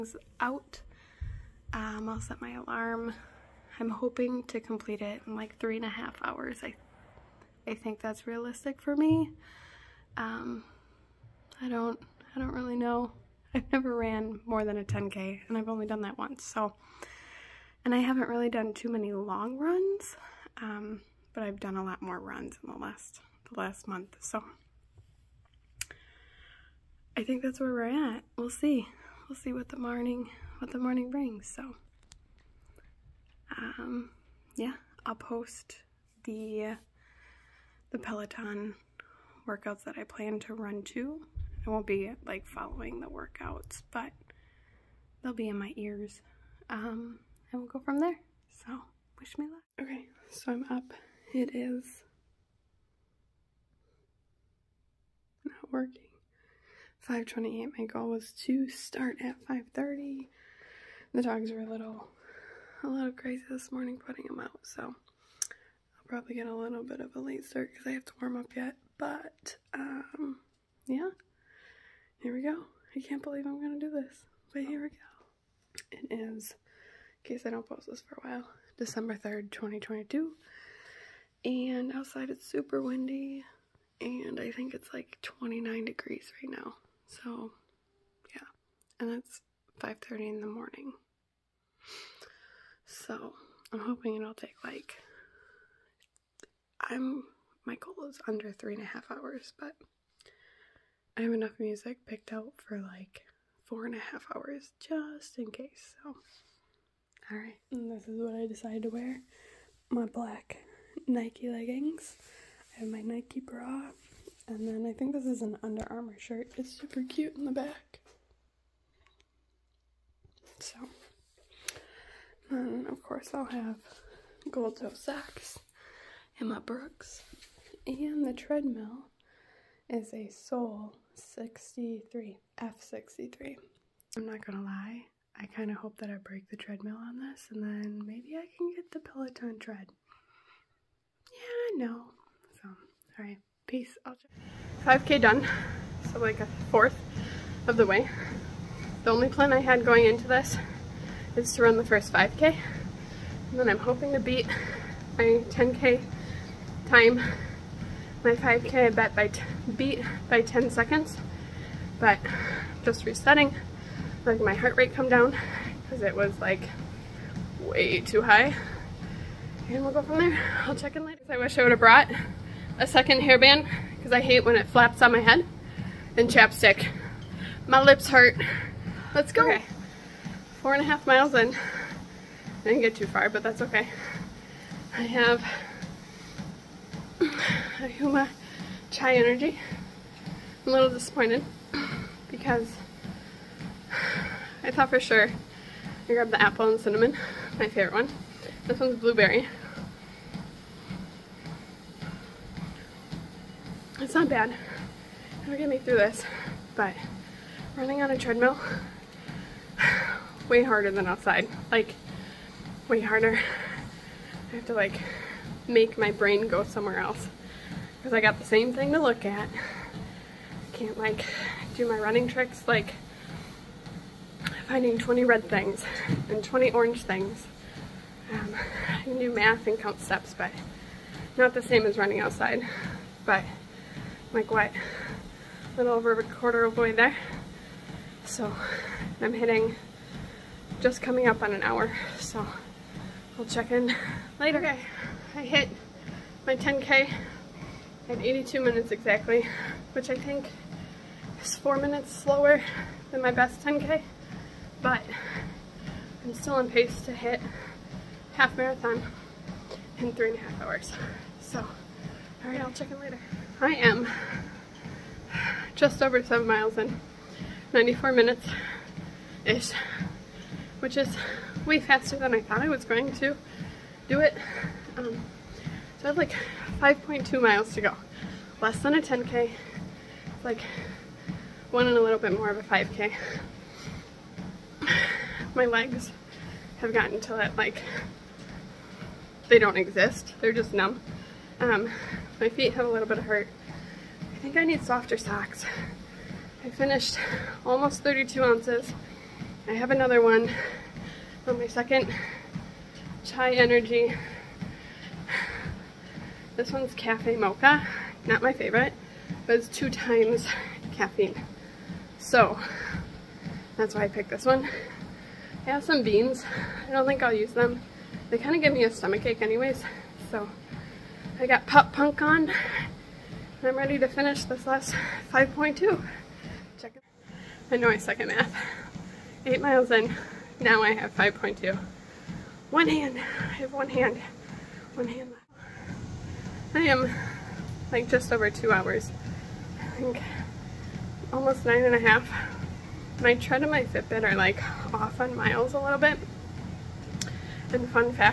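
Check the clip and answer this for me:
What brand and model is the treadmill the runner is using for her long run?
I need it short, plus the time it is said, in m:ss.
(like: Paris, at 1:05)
Sole F63, at 2:10.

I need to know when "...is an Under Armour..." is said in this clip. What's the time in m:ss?
1:55.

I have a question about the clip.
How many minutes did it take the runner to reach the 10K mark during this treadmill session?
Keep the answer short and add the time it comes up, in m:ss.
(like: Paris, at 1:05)
82, at 4:08.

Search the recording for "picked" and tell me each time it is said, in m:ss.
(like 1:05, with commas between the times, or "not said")
1:42, 5:14.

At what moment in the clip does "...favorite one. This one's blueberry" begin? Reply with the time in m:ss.
3:17.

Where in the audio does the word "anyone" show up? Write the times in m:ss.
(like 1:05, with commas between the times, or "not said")
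not said.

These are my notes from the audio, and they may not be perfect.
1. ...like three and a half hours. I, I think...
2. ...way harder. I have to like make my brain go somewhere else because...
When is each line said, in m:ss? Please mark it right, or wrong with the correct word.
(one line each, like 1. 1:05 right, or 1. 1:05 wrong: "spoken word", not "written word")
1. 0:05 right
2. 3:32 right.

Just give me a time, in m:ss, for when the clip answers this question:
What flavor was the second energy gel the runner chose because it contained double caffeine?
5:06.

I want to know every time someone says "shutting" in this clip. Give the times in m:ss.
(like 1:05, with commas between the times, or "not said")
not said.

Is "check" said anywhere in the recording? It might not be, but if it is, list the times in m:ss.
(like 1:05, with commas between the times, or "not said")
2:50, 4:03, 4:22, 5:26.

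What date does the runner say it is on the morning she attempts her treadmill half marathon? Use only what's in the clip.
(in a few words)
December 3rd, 2022.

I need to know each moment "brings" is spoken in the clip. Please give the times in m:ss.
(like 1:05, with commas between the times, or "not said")
0:31.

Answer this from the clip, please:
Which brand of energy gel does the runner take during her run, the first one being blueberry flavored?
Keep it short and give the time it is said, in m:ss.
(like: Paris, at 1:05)
Huma Chia Energy, at 3:07.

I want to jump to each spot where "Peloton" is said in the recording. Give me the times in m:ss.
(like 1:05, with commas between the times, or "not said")
0:37, 2:19.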